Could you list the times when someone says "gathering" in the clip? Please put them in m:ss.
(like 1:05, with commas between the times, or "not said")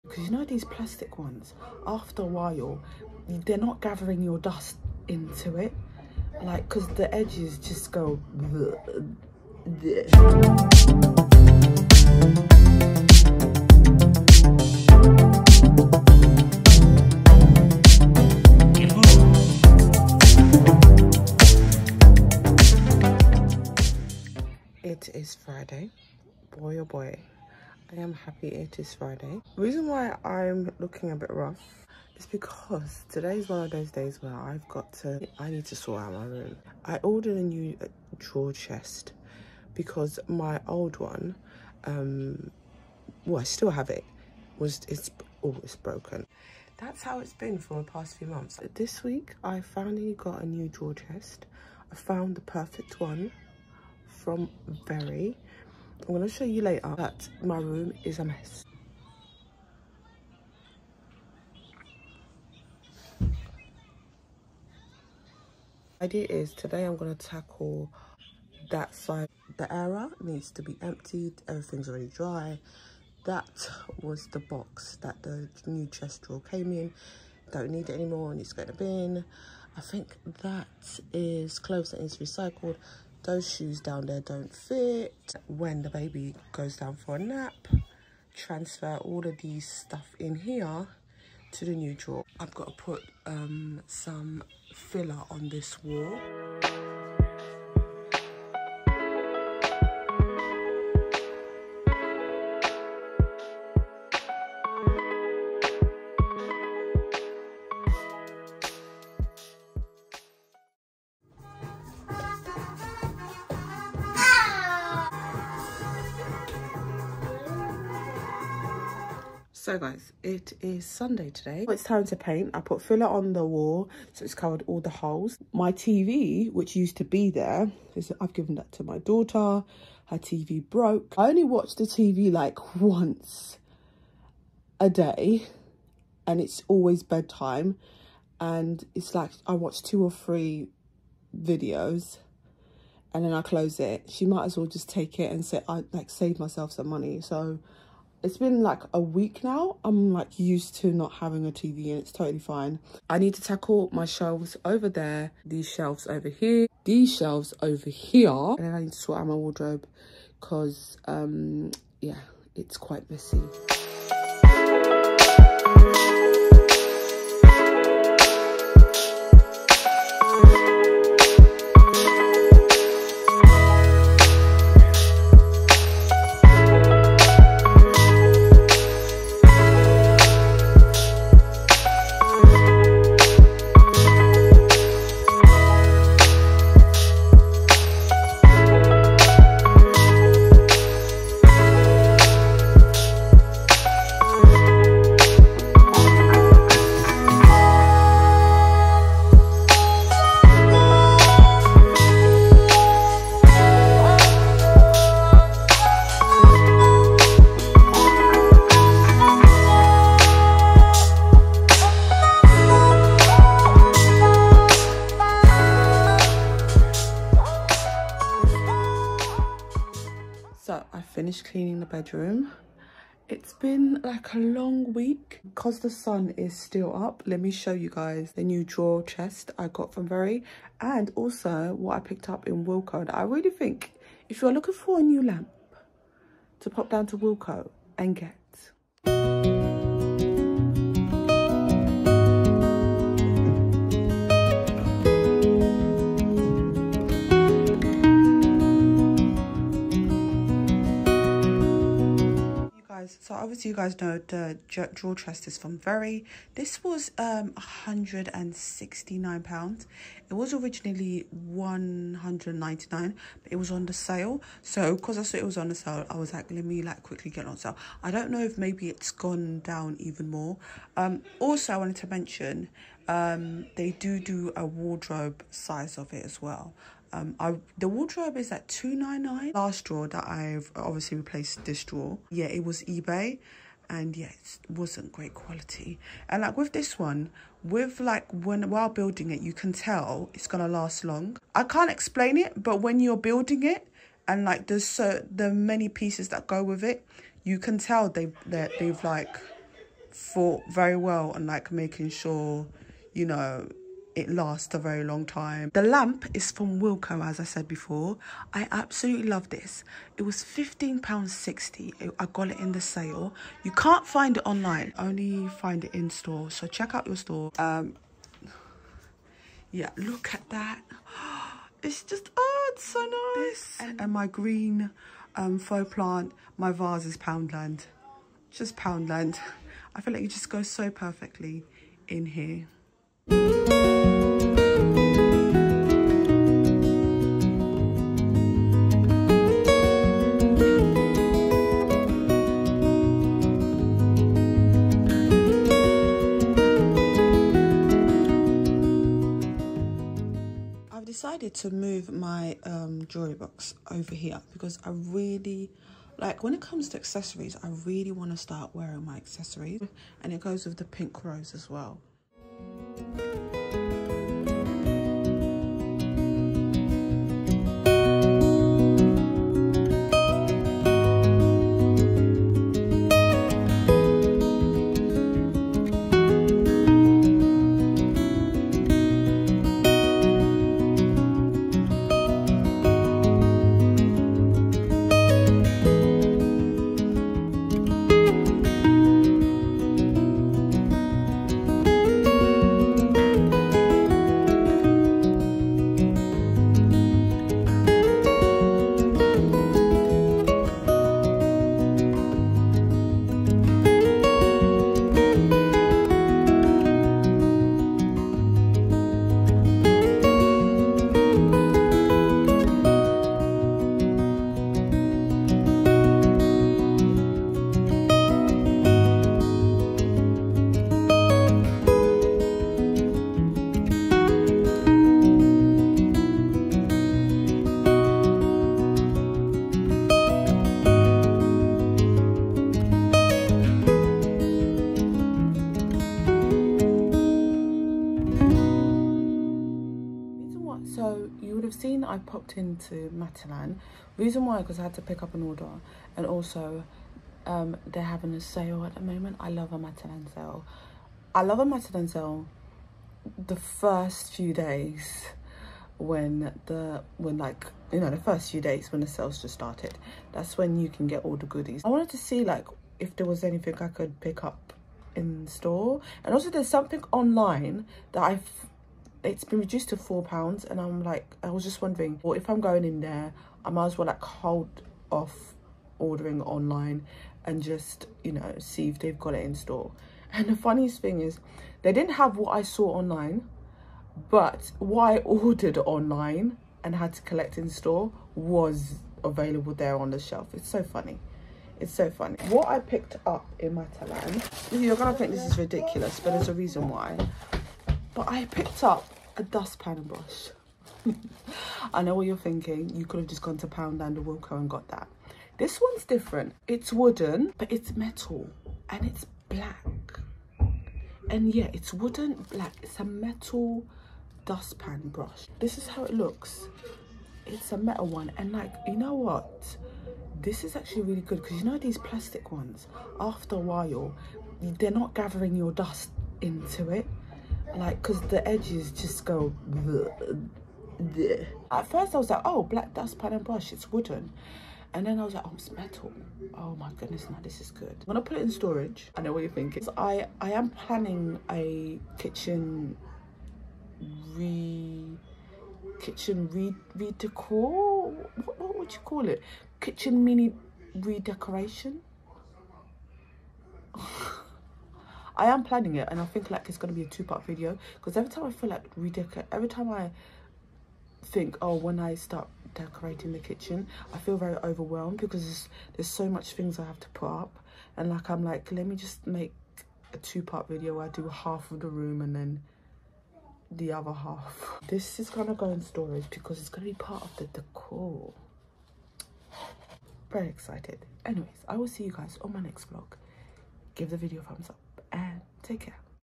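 0:03, 8:45.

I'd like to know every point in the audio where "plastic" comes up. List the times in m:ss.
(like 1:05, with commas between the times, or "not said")
0:00, 8:41.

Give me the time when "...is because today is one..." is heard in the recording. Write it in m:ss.
0:32.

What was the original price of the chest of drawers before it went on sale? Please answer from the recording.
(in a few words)
£199.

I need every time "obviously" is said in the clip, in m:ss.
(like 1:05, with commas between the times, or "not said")
4:13, 4:40.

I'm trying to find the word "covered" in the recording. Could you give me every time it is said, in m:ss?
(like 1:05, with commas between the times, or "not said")
2:04.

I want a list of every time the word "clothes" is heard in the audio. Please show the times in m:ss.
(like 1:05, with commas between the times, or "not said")
1:21.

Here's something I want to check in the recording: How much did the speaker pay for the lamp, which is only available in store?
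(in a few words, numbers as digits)
£15.60.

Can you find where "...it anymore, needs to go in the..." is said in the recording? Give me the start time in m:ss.
1:17.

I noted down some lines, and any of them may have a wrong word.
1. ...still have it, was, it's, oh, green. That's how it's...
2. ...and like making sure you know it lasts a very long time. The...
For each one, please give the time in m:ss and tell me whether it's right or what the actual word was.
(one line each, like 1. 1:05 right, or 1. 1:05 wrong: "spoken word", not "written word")
1. 0:43 wrong: "broken", not "green"
2. 5:01 right.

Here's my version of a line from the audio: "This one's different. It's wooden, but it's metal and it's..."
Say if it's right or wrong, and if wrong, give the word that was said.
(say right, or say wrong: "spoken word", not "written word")
right.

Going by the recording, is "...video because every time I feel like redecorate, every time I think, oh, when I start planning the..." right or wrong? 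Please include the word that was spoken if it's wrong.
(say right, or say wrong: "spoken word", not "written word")
wrong: "decorating", not "planning".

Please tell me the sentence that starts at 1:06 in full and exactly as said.
Idea is today I'm gonna tackle that side.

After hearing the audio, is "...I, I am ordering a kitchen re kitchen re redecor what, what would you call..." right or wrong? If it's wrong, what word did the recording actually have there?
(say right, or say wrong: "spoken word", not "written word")
wrong: "planning", not "ordering".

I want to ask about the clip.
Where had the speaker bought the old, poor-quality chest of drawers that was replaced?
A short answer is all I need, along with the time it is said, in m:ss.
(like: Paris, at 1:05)
eBay, at 4:42.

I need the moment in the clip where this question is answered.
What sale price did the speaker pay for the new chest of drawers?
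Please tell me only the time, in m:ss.
4:17.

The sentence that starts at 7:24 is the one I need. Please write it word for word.
Reason why, because I had to pick up an order and also um, they're having a sale at the moment.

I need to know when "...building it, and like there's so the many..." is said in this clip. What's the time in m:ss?
4:53.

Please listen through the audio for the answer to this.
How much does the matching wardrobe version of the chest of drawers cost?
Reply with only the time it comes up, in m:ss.
4:38.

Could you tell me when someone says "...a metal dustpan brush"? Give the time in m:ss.
8:32.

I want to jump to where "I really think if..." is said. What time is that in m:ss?
3:53.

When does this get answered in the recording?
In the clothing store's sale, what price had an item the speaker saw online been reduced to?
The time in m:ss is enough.
7:49.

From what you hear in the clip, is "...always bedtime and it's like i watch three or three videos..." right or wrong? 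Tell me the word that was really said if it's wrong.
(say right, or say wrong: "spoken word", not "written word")
wrong: "two", not "three".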